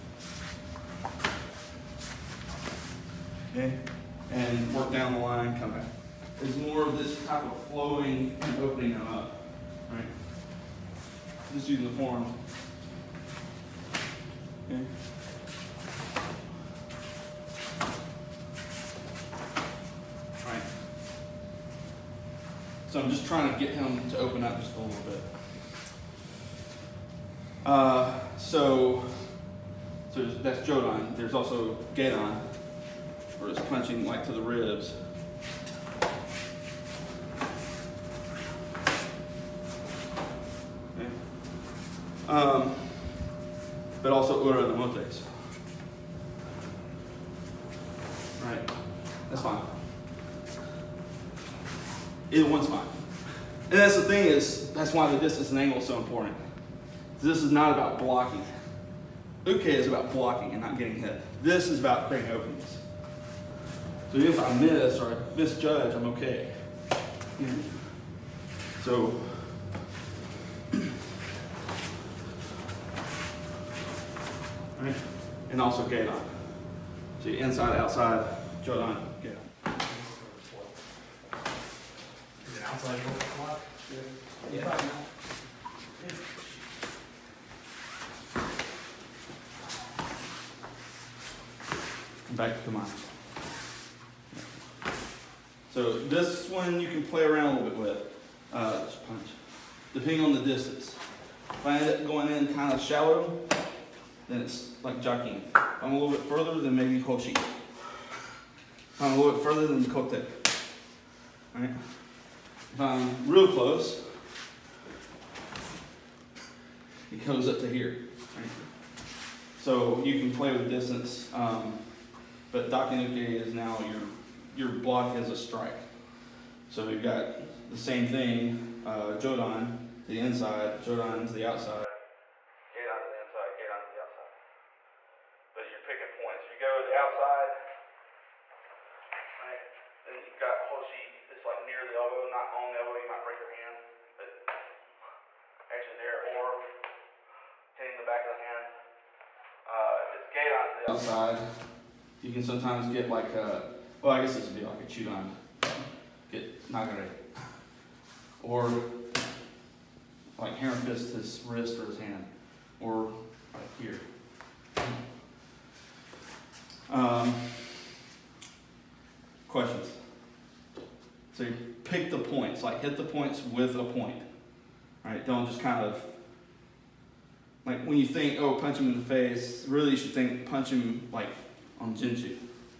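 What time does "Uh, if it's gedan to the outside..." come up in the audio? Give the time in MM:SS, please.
02:29.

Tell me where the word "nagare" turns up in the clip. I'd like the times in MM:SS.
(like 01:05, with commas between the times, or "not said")
02:36.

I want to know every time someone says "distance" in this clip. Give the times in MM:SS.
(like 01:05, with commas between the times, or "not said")
00:55, 01:40, 02:00.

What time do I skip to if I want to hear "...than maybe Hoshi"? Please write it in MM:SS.
01:46.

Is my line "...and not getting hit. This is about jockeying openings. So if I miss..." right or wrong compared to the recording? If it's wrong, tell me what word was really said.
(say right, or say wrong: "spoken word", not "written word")
wrong: "creating", not "jockeying".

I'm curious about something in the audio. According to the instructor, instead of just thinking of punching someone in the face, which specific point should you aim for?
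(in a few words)
Jinchu.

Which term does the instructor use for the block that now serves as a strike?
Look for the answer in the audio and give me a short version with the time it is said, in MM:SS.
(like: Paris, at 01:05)
Daken uke, at 02:02.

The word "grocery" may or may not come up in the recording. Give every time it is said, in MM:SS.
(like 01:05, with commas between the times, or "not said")
not said.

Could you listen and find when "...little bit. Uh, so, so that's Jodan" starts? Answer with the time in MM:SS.
00:24.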